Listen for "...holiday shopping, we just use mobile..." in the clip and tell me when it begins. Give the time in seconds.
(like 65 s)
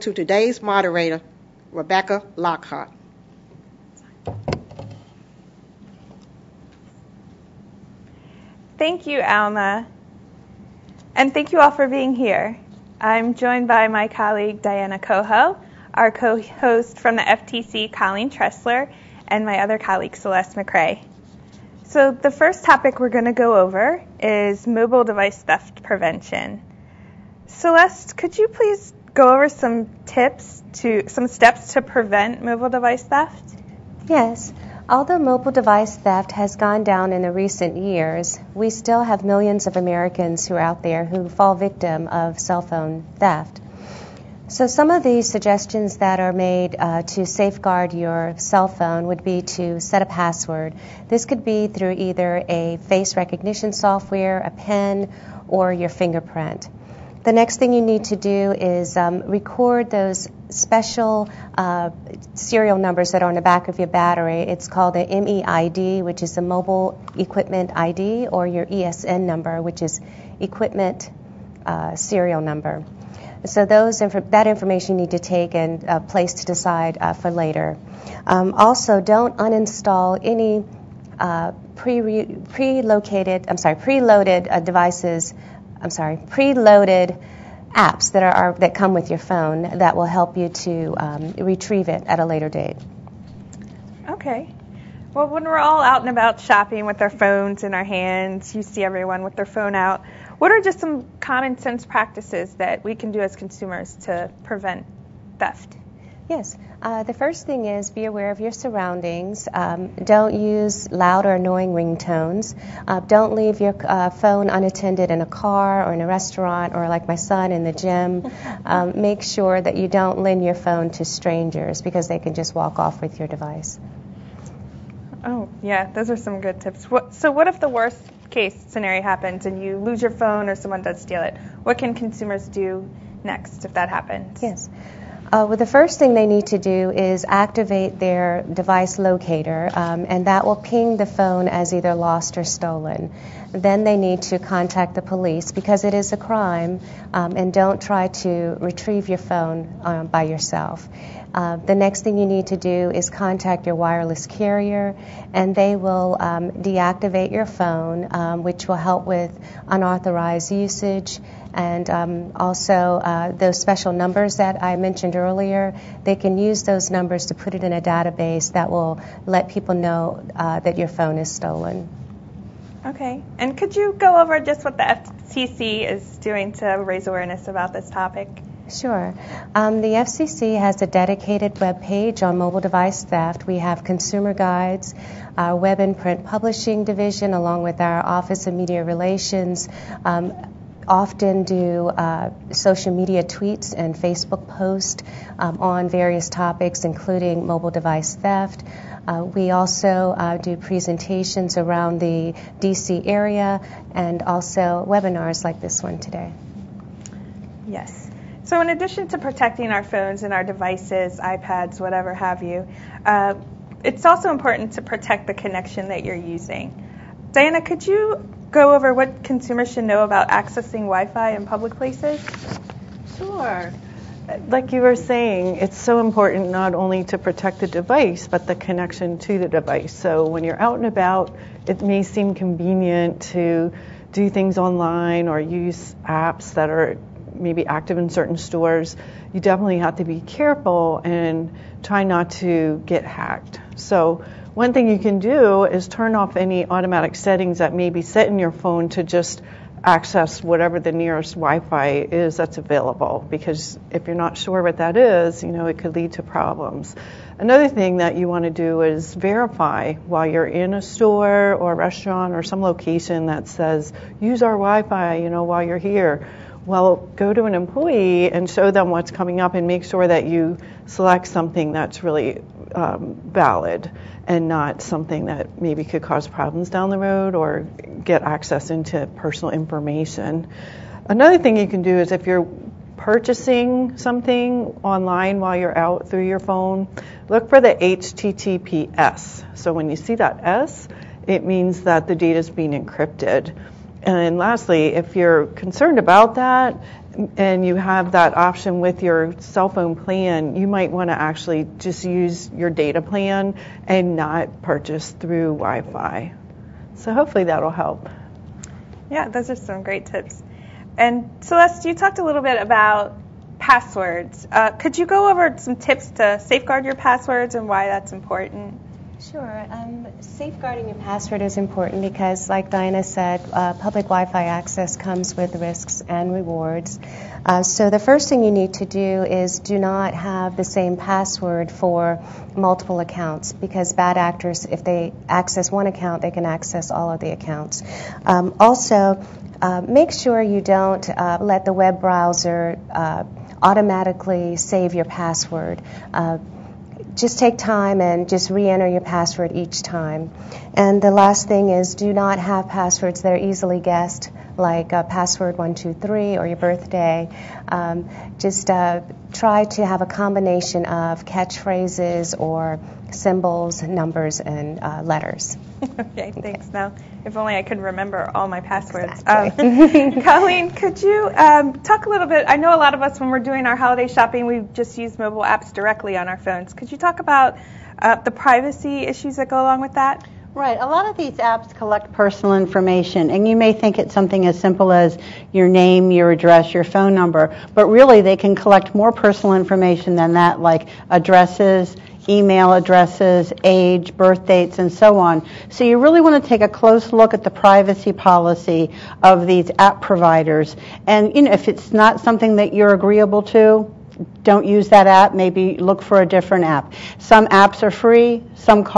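373 s.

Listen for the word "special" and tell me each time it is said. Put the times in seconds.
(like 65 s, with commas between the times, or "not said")
60 s, 163 s.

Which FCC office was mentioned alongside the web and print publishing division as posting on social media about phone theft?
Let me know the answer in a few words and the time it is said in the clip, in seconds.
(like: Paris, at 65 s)
Office of Media Relations, at 188 s.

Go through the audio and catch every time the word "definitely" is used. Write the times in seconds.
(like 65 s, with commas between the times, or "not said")
239 s.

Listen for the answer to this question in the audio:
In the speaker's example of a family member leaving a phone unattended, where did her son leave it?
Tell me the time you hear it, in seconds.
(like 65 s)
117 s.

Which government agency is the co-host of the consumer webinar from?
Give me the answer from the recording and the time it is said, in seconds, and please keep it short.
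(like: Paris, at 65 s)
FTC, at 17 s.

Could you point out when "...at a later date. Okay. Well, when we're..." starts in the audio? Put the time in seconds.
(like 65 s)
92 s.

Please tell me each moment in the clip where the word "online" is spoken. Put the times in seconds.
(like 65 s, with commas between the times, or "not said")
234 s, 284 s.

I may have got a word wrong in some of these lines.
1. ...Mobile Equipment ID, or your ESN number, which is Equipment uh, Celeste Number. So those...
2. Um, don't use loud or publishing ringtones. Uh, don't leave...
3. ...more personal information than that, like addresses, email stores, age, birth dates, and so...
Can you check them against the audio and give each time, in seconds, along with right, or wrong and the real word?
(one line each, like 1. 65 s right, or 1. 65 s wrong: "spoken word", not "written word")
1. 66 s wrong: "Serial", not "Celeste"
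2. 109 s wrong: "annoying", not "publishing"
3. 388 s wrong: "addresses", not "stores".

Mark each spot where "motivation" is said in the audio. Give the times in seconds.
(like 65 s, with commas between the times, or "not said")
not said.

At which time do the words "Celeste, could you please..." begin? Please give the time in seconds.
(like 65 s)
27 s.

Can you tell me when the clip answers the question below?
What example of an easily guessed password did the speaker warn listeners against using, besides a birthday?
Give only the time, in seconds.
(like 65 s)
355 s.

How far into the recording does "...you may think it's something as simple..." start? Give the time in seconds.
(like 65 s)
383 s.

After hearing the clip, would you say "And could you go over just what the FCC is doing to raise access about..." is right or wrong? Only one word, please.
wrong.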